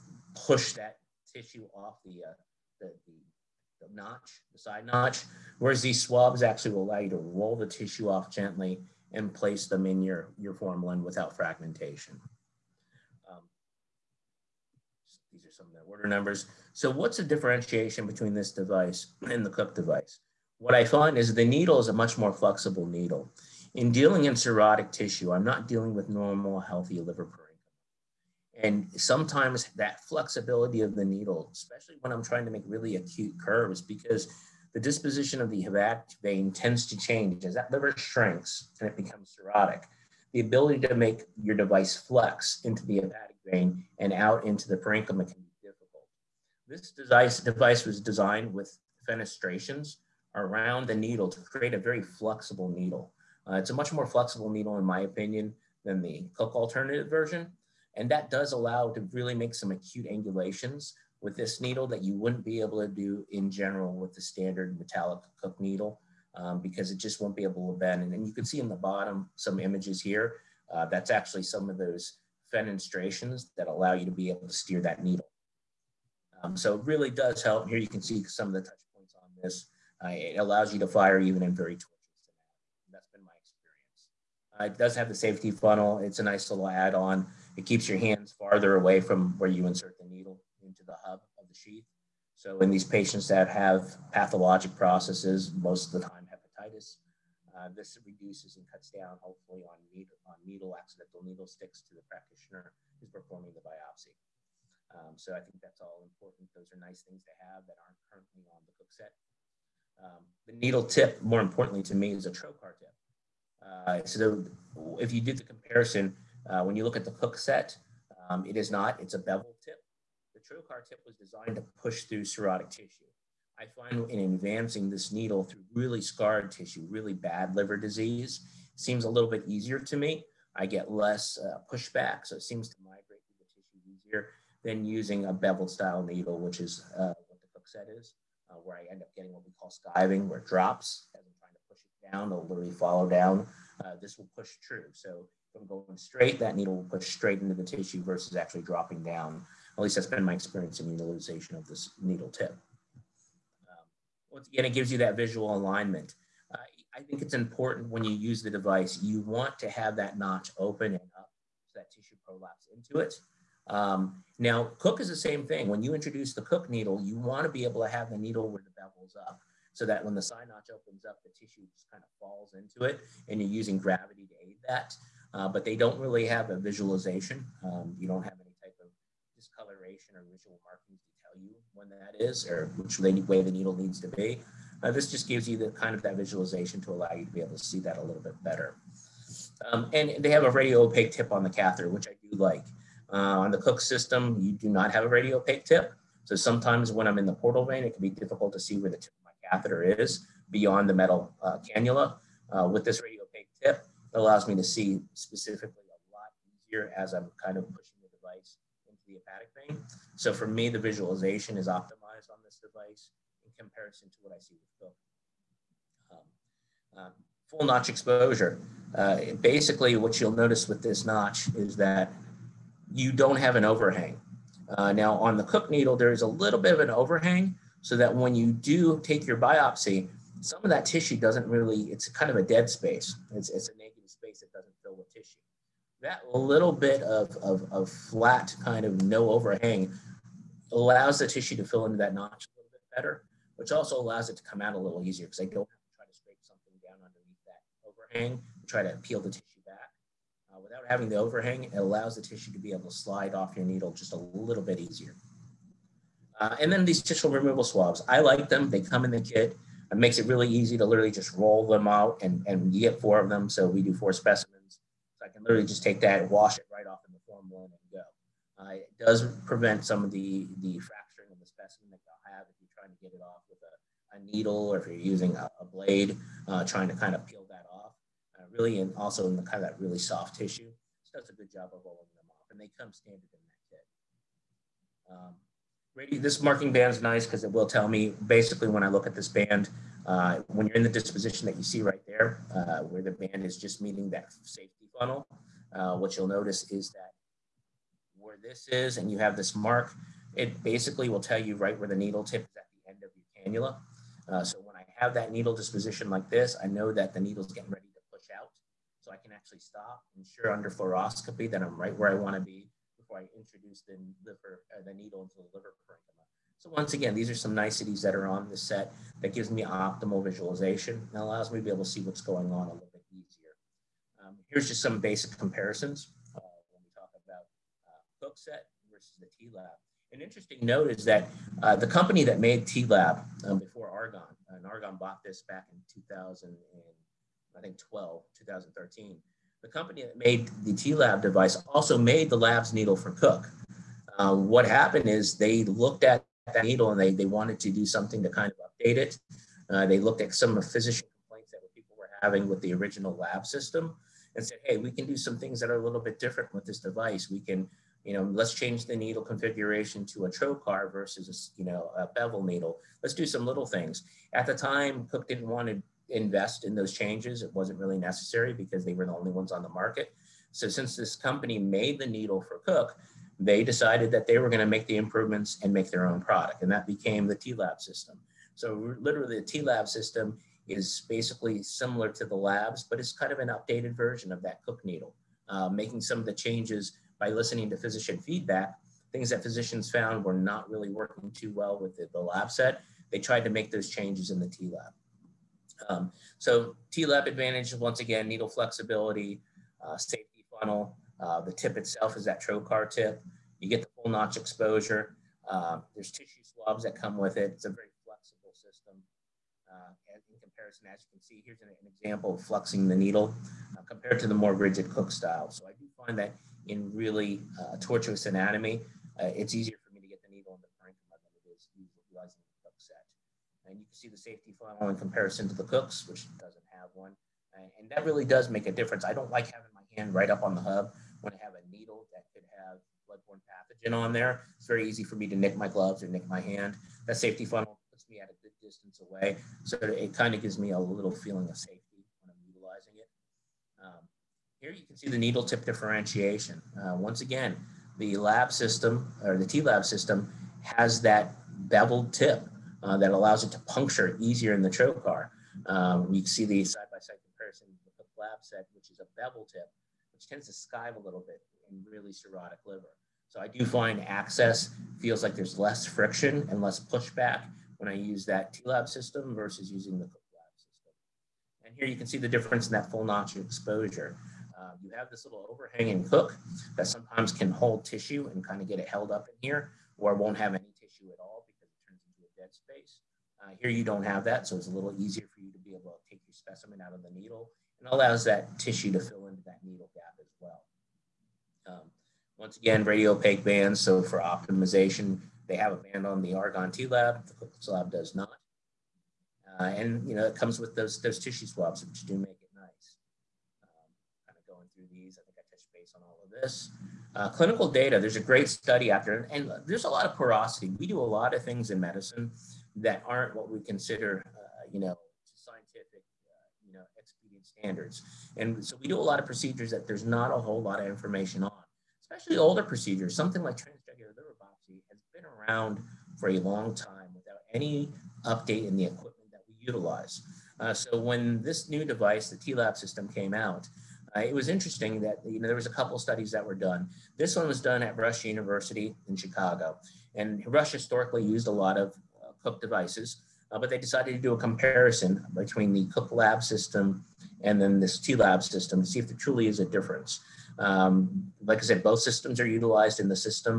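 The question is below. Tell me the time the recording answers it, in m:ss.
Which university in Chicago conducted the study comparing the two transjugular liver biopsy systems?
8:57.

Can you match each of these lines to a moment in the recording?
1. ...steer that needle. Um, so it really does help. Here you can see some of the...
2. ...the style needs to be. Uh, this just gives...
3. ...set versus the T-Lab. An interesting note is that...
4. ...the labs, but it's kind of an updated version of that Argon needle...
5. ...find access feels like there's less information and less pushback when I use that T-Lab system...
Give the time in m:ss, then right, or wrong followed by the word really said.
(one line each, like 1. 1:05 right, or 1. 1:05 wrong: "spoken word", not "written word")
1. 1:14 right
2. 3:03 wrong: "needle", not "style"
3. 5:28 right
4. 6:22 wrong: "Cook", not "Argon"
5. 7:43 wrong: "friction", not "information".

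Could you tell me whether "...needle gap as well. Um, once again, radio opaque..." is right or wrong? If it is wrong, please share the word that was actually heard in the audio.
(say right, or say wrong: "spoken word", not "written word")
right.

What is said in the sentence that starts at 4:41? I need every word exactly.
So that's a good job of rolling them off.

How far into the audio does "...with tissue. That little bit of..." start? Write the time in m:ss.
3:54.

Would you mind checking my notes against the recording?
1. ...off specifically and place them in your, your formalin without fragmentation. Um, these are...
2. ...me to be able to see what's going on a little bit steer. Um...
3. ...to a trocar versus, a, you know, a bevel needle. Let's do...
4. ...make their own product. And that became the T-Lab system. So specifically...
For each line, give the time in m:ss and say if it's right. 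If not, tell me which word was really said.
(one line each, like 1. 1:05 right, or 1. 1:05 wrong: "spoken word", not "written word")
1. 0:08 wrong: "gently", not "specifically"
2. 5:21 wrong: "easier", not "steer"
3. 6:00 right
4. 6:15 wrong: "literally", not "specifically".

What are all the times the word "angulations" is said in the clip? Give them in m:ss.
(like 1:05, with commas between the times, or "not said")
1:00.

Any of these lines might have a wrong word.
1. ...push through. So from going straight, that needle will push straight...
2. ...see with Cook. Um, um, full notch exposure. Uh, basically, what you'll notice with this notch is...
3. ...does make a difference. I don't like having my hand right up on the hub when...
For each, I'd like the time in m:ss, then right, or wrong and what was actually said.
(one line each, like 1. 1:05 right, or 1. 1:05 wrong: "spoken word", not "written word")
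1. 2:24 right
2. 3:34 right
3. 7:08 right.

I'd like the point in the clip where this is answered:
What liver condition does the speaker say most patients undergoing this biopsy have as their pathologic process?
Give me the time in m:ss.
1:36.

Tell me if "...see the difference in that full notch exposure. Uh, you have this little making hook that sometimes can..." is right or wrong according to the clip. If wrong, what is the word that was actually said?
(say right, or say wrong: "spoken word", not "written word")
wrong: "overhanging", not "making".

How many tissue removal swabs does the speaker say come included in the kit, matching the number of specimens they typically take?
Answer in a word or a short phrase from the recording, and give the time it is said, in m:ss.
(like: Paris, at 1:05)
4, at 4:22.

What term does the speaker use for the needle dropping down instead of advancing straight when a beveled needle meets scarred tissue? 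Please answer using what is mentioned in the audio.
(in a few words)
Skiving.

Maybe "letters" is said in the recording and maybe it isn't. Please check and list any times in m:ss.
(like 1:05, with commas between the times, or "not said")
not said.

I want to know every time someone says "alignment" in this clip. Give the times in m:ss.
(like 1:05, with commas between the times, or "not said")
2:35.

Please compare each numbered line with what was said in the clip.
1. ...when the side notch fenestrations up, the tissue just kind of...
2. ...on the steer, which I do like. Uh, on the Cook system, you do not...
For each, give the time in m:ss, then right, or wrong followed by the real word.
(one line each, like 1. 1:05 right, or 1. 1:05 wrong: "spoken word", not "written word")
1. 2:50 wrong: "opens", not "fenestrations"
2. 3:11 wrong: "catheter", not "steer".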